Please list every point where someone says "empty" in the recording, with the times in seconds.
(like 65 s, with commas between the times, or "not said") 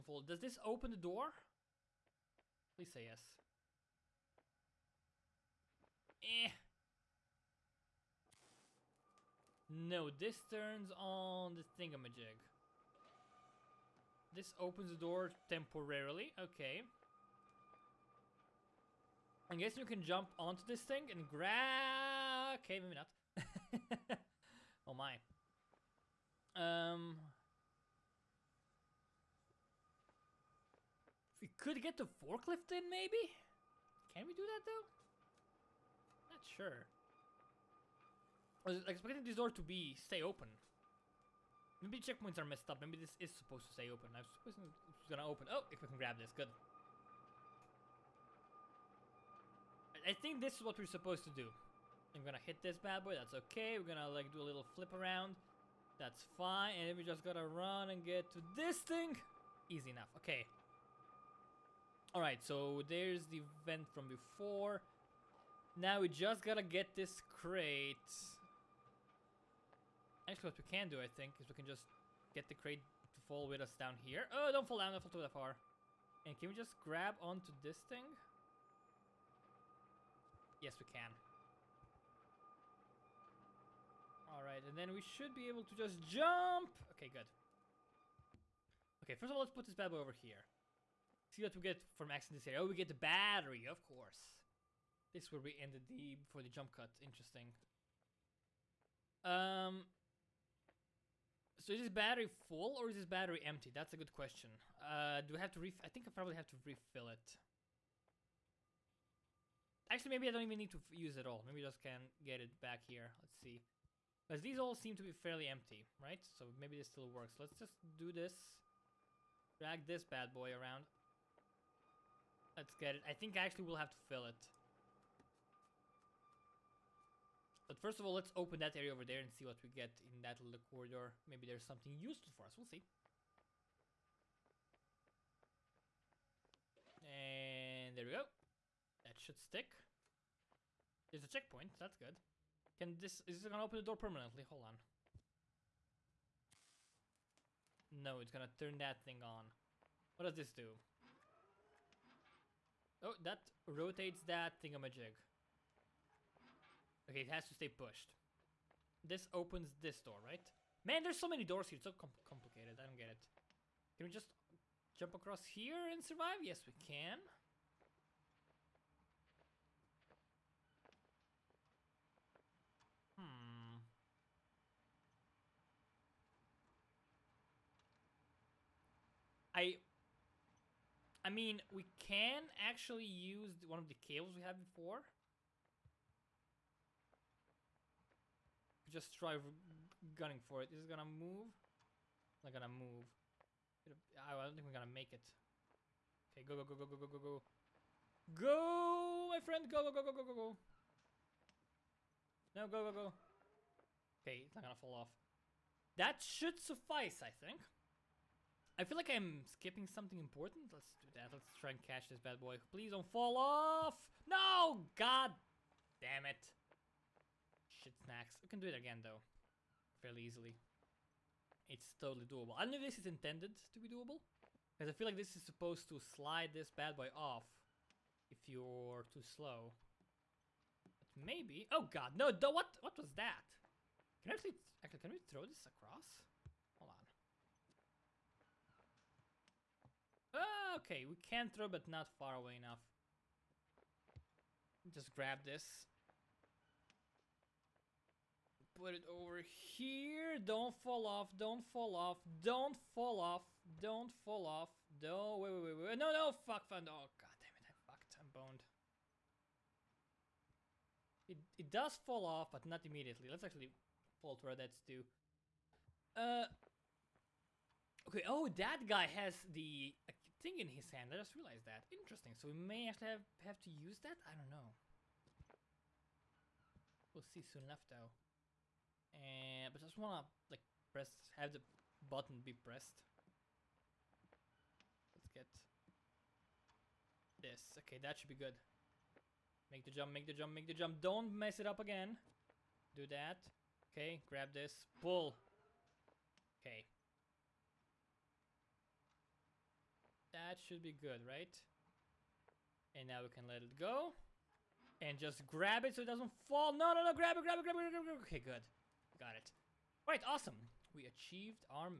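103 s, 115 s.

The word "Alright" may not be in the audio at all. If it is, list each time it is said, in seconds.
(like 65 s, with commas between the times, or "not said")
62 s, 84 s, 310 s.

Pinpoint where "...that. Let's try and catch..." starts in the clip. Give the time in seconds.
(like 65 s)
211 s.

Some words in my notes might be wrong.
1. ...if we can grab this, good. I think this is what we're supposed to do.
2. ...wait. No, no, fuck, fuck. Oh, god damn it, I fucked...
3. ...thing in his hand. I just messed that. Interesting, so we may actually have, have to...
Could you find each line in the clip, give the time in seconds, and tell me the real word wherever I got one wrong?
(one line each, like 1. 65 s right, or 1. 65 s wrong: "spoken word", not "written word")
1. 45 s right
2. 255 s right
3. 270 s wrong: "realized", not "messed".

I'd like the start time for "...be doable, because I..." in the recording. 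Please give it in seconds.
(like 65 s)
223 s.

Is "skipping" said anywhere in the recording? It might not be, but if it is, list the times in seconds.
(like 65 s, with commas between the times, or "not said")
209 s.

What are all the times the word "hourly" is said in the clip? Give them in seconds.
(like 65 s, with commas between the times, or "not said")
not said.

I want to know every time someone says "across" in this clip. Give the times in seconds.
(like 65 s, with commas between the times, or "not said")
165 s, 235 s.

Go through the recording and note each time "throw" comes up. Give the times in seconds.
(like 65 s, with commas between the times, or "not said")
235 s, 241 s.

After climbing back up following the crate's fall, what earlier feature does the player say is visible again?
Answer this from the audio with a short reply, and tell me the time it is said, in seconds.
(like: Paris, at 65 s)
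the vent, at 63 s.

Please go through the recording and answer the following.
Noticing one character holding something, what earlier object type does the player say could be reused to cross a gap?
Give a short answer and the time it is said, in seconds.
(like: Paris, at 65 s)
cables, at 183 s.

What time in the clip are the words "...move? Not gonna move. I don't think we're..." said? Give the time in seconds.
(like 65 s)
191 s.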